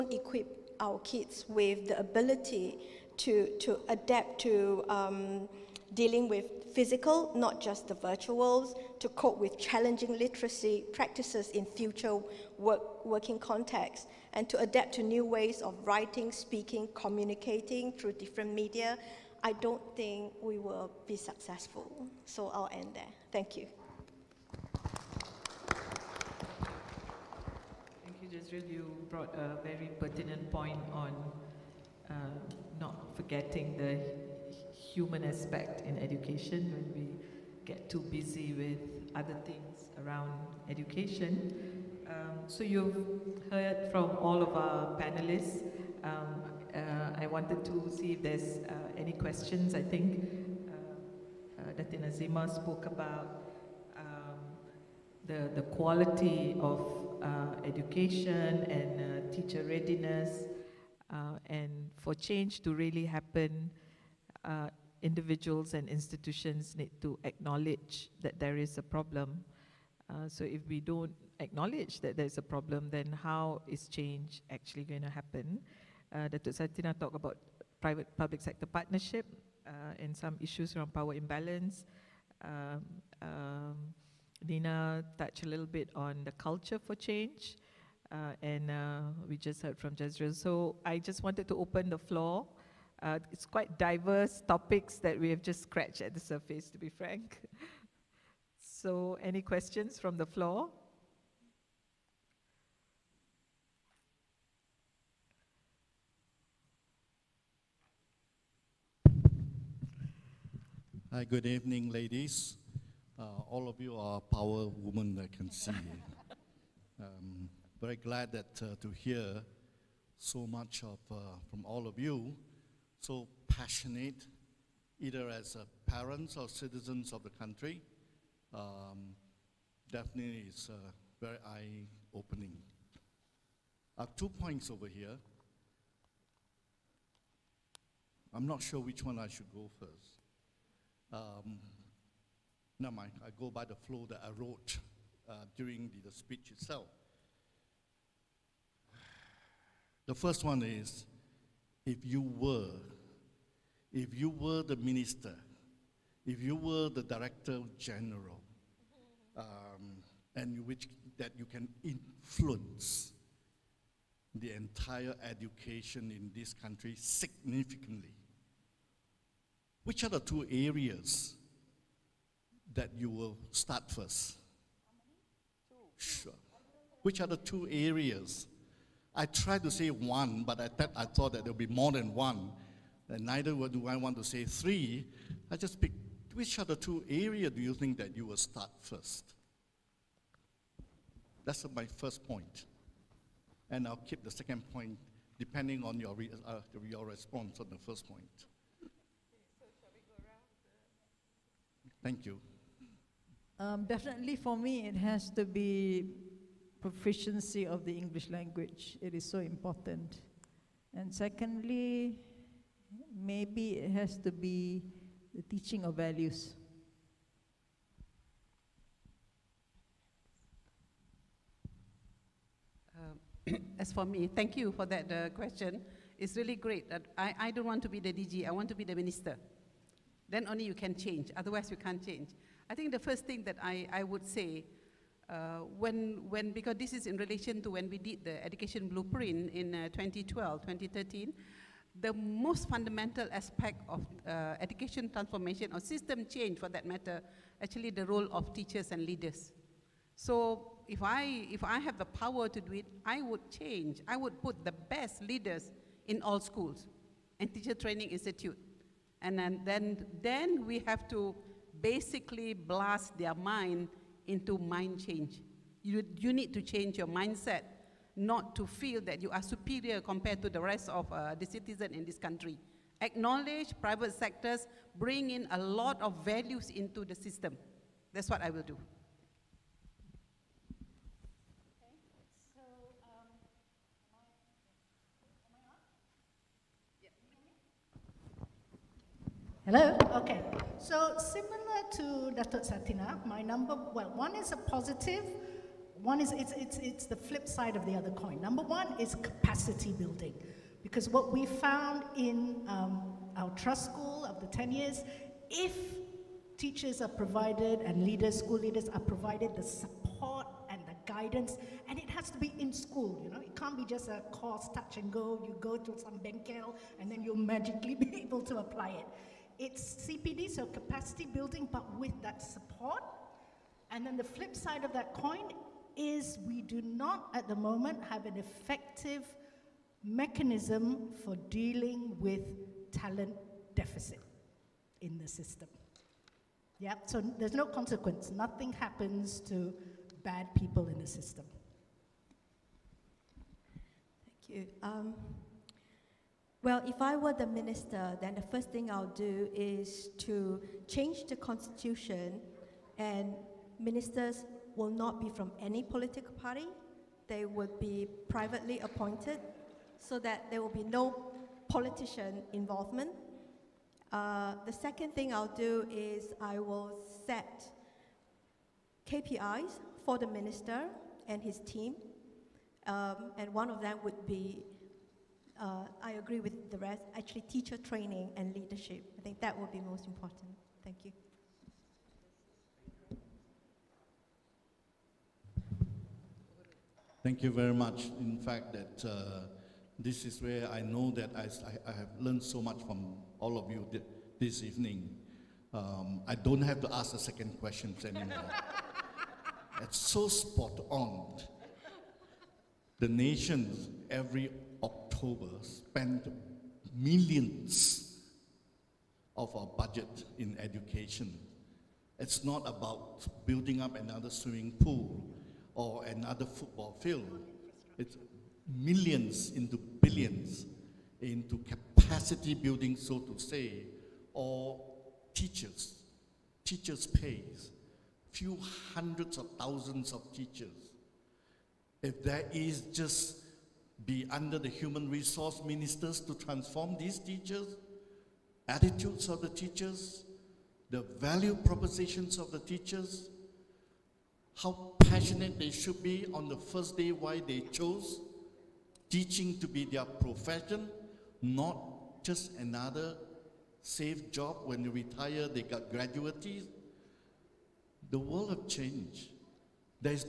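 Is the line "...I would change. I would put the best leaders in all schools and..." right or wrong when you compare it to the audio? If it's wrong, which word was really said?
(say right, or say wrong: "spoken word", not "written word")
right.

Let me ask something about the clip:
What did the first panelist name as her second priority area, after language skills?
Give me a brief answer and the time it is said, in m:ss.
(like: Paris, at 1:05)
Teaching of values, at 3:35.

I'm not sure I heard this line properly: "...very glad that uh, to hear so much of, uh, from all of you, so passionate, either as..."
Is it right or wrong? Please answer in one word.
right.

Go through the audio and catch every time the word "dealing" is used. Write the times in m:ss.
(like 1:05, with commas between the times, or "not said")
0:05, 5:31.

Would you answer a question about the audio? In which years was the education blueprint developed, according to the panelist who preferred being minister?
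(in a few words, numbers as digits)
2012, 2013.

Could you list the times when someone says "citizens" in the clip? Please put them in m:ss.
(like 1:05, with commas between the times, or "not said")
2:06, 4:31.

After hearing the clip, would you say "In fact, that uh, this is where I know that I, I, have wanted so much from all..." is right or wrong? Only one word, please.
wrong.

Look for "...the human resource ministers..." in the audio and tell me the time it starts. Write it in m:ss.
7:14.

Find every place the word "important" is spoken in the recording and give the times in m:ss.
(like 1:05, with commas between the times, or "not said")
3:29, 6:20.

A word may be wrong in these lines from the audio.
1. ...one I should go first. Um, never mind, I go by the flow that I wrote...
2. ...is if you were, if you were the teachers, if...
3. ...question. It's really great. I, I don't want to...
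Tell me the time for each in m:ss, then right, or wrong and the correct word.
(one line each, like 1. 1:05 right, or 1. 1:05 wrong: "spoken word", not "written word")
1. 2:19 right
2. 2:30 wrong: "minister", not "teachers"
3. 3:45 right.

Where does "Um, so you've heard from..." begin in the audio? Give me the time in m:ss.
0:42.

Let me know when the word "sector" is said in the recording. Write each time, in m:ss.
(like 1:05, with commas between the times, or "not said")
1:18, 4:34.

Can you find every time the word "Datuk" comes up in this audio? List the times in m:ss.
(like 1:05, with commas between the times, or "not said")
1:16, 4:52.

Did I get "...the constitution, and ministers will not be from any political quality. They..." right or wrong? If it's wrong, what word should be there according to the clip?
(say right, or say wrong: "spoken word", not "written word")
wrong: "party", not "quality".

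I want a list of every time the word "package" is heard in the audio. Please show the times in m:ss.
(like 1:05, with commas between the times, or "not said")
not said.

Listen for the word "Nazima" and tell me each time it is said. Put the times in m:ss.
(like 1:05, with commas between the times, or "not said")
0:52.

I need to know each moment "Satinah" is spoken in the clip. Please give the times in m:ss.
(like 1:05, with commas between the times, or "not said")
1:16, 4:52.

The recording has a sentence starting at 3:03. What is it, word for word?
And neither do I want to say three.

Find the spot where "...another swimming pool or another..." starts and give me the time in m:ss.
6:53.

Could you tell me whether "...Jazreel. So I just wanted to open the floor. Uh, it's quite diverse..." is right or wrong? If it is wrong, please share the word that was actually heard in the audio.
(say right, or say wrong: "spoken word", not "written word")
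right.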